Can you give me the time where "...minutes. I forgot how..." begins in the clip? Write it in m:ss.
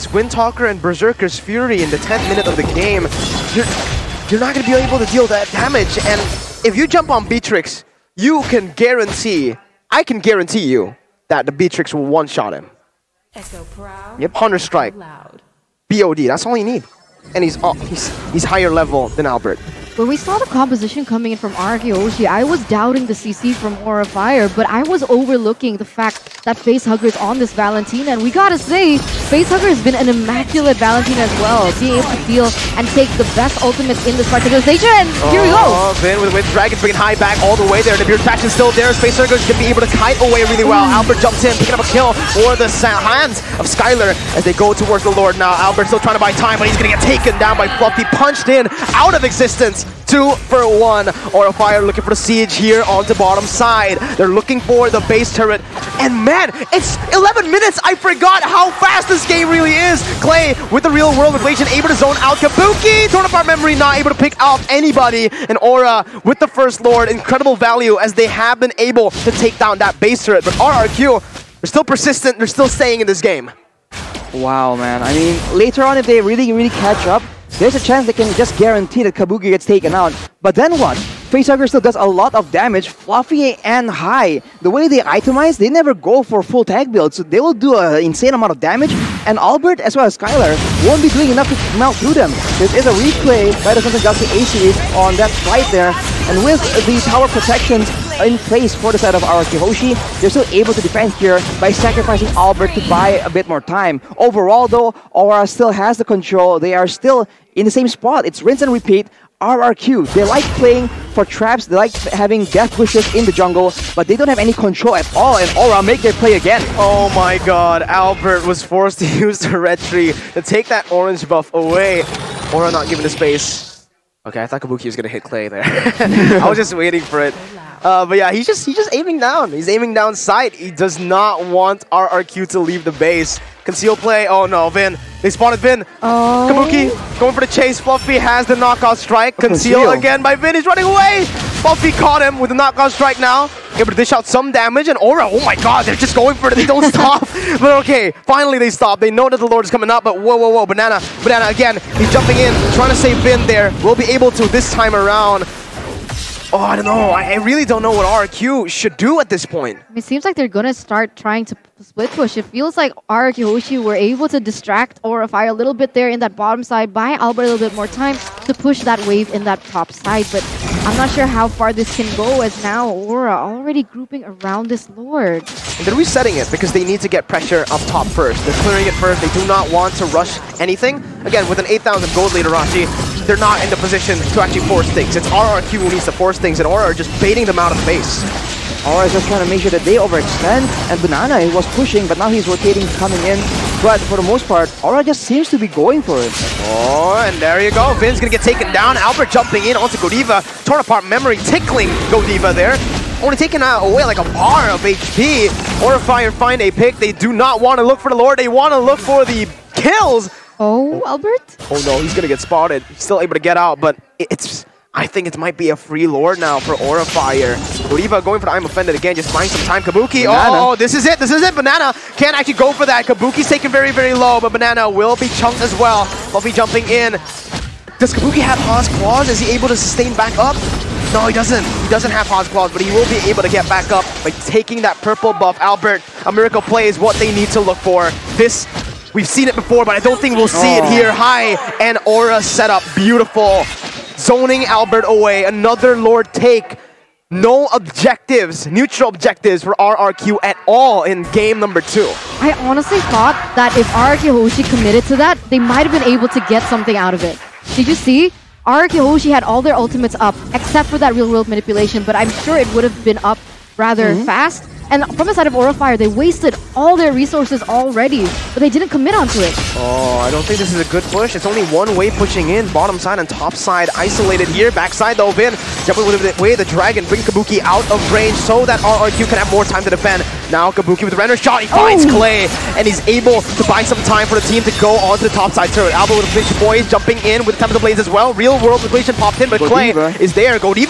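0:57.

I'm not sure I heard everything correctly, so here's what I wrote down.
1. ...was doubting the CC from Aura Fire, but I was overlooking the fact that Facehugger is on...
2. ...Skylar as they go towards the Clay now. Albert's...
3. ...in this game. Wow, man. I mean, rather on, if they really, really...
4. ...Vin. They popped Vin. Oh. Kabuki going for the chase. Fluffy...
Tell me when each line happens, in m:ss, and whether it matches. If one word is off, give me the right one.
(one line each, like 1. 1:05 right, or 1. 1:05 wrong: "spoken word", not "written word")
1. 0:22 right
2. 0:43 wrong: "Lord", not "Clay"
3. 1:13 wrong: "later", not "rather"
4. 2:14 wrong: "spotted", not "popped".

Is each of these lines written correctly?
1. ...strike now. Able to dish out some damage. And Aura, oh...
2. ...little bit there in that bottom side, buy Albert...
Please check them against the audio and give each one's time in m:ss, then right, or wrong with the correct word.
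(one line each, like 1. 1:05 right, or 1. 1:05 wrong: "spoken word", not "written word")
1. 2:22 right
2. 2:45 right.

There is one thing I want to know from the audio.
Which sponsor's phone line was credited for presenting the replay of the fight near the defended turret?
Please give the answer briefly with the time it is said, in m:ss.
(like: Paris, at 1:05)
Samsung Galaxy A-Series, at 1:33.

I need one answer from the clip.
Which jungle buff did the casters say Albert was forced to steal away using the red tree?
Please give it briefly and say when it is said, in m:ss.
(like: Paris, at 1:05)
orange buff, at 2:00.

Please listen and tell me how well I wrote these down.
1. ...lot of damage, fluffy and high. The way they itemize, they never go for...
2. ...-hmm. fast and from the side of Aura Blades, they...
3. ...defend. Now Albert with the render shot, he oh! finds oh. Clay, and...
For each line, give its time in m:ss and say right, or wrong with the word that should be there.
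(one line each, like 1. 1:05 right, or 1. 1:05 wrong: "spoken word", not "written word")
1. 1:22 right
2. 4:24 wrong: "Fire", not "Blades"
3. 4:39 wrong: "Kabuki", not "Albert".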